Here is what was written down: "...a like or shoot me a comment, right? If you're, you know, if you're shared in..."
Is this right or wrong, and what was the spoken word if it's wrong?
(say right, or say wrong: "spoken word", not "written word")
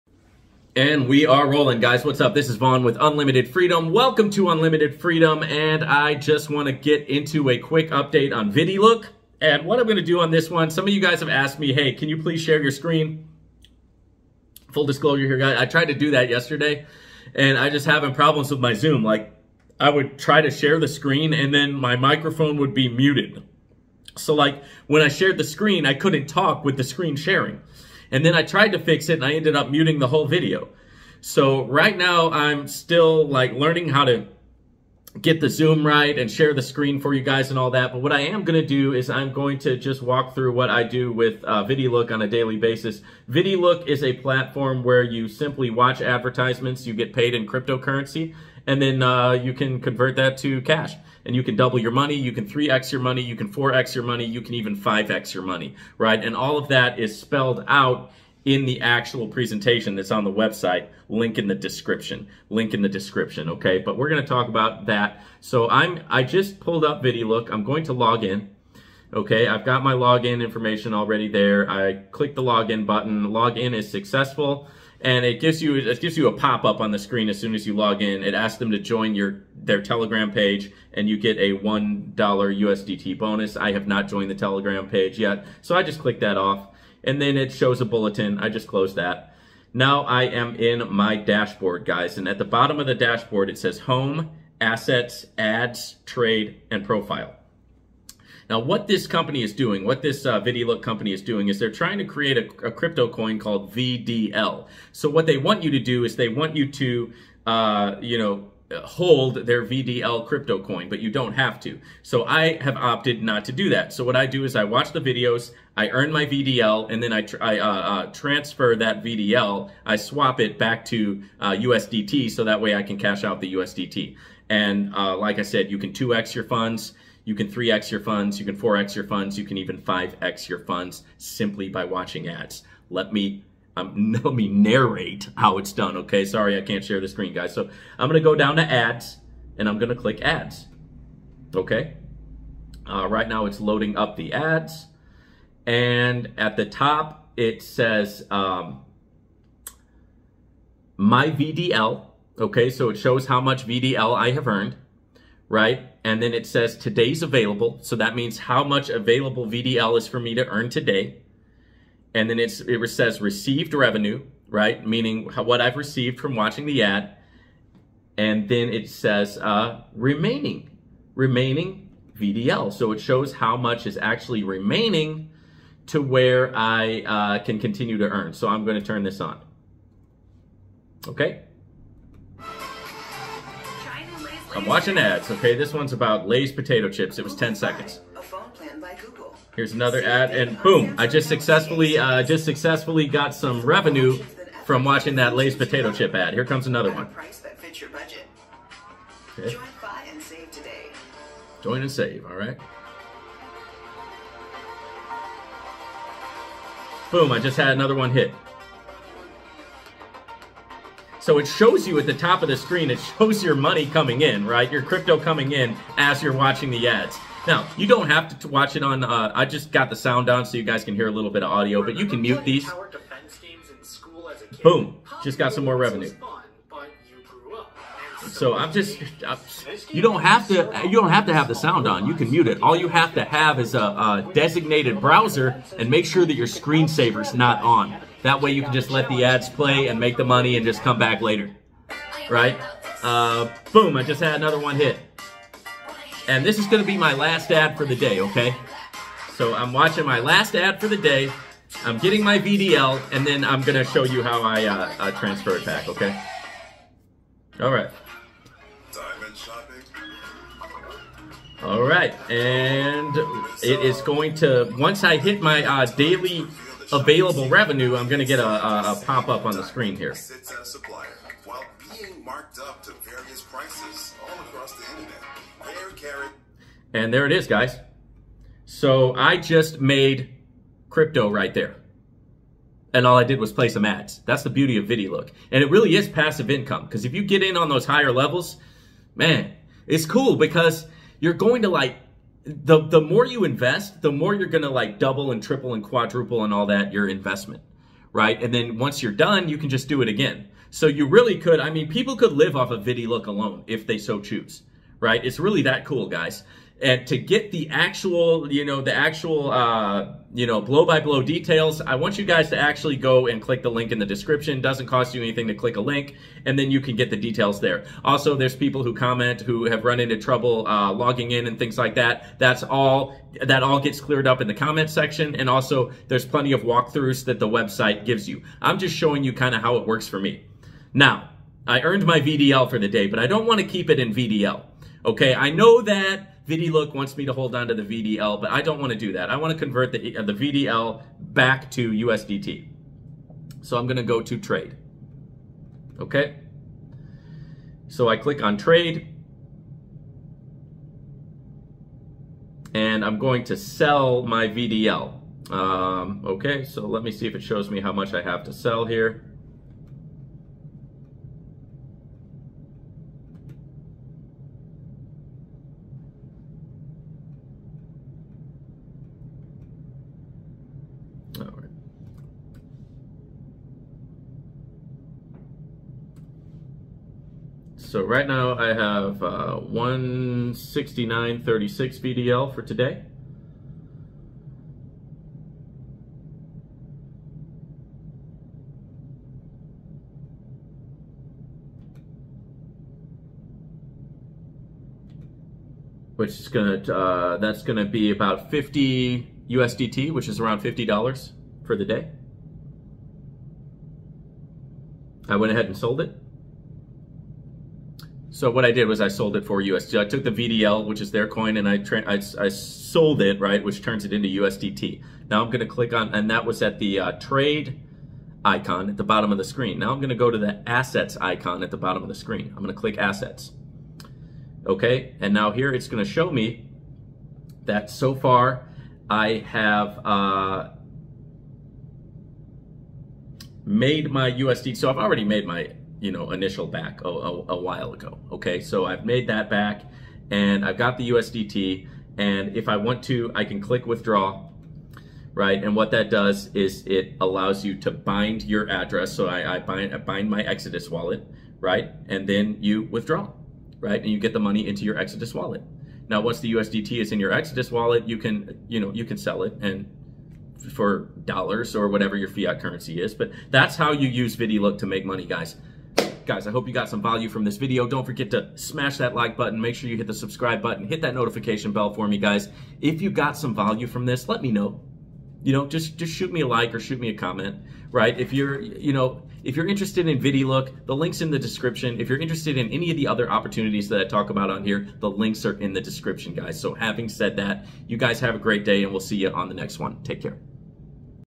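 wrong: "interested", not "shared".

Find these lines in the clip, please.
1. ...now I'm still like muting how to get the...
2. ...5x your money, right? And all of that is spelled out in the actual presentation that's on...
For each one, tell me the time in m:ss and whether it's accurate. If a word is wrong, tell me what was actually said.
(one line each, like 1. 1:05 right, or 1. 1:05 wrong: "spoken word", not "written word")
1. 0:31 wrong: "learning", not "muting"
2. 0:54 right.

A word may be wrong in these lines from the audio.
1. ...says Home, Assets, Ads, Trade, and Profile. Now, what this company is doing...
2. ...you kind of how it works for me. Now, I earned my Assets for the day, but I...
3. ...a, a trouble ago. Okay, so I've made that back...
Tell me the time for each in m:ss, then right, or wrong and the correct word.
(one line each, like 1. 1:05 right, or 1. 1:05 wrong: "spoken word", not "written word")
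1. 1:33 right
2. 5:29 wrong: "VDL", not "Assets"
3. 7:17 wrong: "while", not "trouble".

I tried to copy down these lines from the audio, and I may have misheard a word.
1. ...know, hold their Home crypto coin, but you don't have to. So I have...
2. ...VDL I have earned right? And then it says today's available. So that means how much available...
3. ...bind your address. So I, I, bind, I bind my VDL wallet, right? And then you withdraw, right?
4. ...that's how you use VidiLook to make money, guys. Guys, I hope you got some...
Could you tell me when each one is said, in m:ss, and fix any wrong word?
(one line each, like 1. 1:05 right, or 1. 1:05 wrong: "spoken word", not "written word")
1. 1:48 wrong: "VDL", not "Home"
2. 2:33 right
3. 7:27 wrong: "Exodus", not "VDL"
4. 7:43 right.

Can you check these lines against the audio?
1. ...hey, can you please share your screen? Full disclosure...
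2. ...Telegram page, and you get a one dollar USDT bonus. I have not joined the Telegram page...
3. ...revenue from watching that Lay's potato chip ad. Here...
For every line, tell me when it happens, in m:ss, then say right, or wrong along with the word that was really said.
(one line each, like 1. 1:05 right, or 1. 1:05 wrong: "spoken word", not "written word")
1. 0:11 right
2. 1:19 right
3. 3:13 right.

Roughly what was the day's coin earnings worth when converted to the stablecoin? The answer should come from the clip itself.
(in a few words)
50 USDT.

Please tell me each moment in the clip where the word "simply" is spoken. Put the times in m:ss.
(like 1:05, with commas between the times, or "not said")
0:45, 2:11.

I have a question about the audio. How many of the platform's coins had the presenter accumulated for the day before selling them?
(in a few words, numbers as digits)
169.36.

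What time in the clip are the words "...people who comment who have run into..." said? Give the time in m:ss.
5:18.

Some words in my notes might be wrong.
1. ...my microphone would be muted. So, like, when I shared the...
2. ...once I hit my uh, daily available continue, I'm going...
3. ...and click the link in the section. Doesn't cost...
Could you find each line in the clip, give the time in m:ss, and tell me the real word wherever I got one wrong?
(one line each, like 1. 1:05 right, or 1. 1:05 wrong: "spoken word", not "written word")
1. 0:21 right
2. 4:24 wrong: "revenue", not "continue"
3. 5:13 wrong: "description", not "section".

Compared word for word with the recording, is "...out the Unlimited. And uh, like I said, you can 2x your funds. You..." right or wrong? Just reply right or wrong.
wrong.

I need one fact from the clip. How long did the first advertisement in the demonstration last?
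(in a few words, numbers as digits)
10 seconds.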